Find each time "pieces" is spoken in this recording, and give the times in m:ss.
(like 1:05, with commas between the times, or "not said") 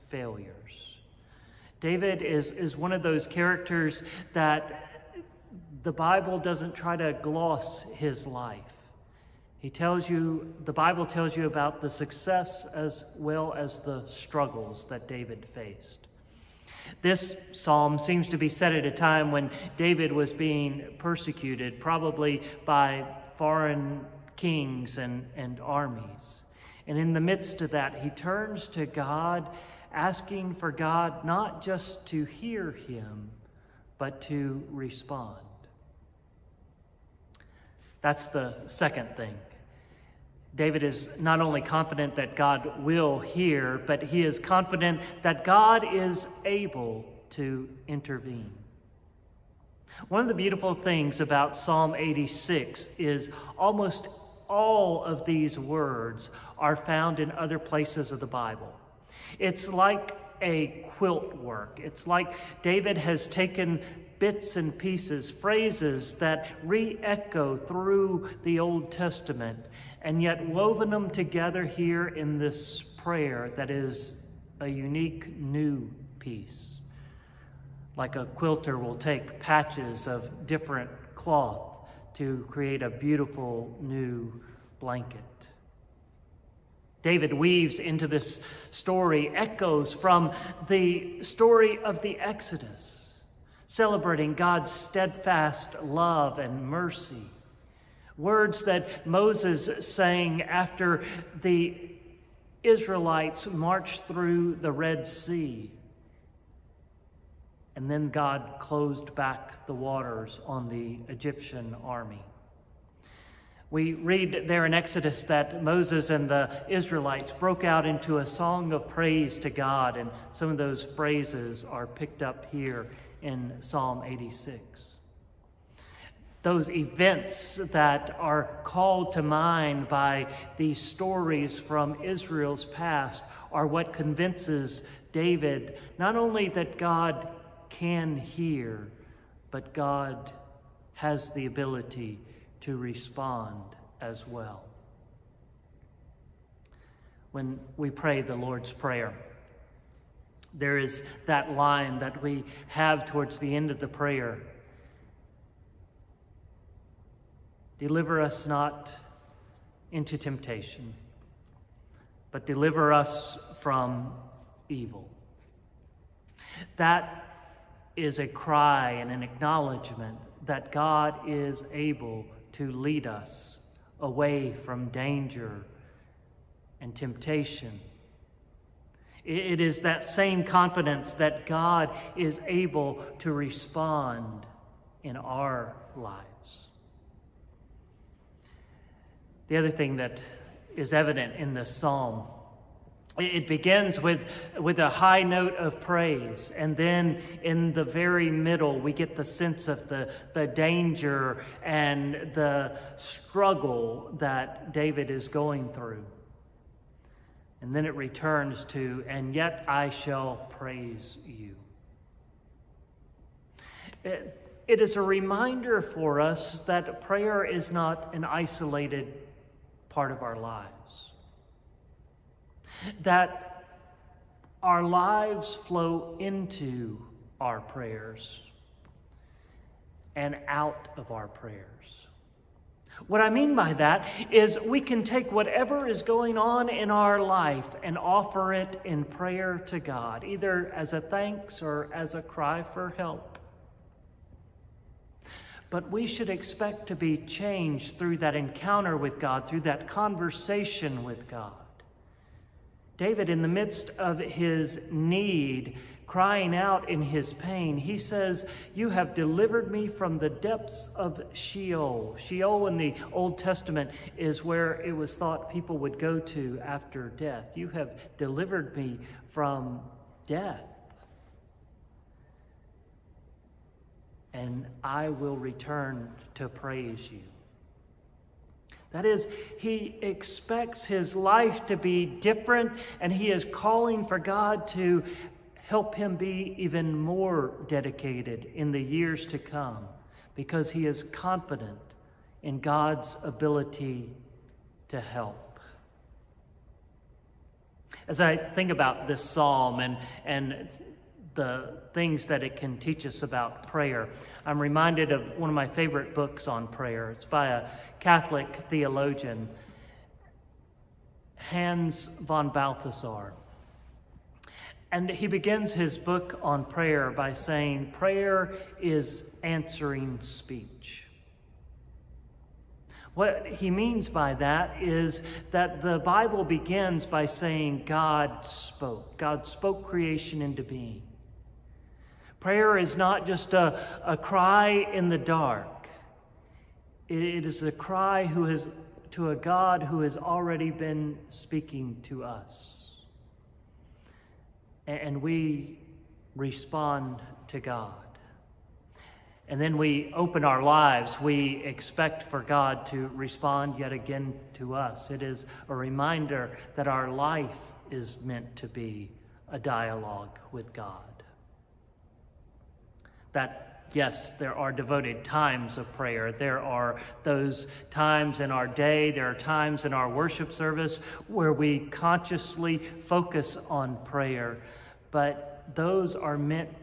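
1:04, 1:16.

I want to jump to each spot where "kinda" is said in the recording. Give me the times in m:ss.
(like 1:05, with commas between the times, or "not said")
not said.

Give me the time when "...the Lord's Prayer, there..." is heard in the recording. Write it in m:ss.
2:28.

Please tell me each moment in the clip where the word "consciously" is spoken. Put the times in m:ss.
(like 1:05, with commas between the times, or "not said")
6:11.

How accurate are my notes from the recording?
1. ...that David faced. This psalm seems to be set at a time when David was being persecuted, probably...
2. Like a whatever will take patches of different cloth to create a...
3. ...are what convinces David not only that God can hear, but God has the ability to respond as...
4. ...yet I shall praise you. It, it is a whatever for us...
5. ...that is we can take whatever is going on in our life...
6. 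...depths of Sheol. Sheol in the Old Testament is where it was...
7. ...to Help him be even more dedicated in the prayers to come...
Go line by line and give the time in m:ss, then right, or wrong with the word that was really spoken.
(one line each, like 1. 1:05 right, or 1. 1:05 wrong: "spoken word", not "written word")
1. 0:14 right
2. 1:17 wrong: "quilter", not "whatever"
3. 2:13 right
4. 3:29 wrong: "reminder", not "whatever"
5. 3:53 right
6. 4:20 right
7. 4:44 wrong: "years", not "prayers".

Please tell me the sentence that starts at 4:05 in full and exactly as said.
But we should expect to be changed through that encounter with God, through that conversation with God.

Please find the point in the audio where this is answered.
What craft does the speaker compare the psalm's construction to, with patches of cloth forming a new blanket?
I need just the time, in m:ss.
1:00.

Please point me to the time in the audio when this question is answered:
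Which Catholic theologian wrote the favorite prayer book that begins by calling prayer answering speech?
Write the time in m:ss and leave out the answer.
5:11.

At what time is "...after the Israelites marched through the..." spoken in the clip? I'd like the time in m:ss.
1:40.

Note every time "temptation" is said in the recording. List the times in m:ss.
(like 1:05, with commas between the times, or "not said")
2:40, 2:56.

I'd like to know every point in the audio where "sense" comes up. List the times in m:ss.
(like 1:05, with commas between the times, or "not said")
3:19.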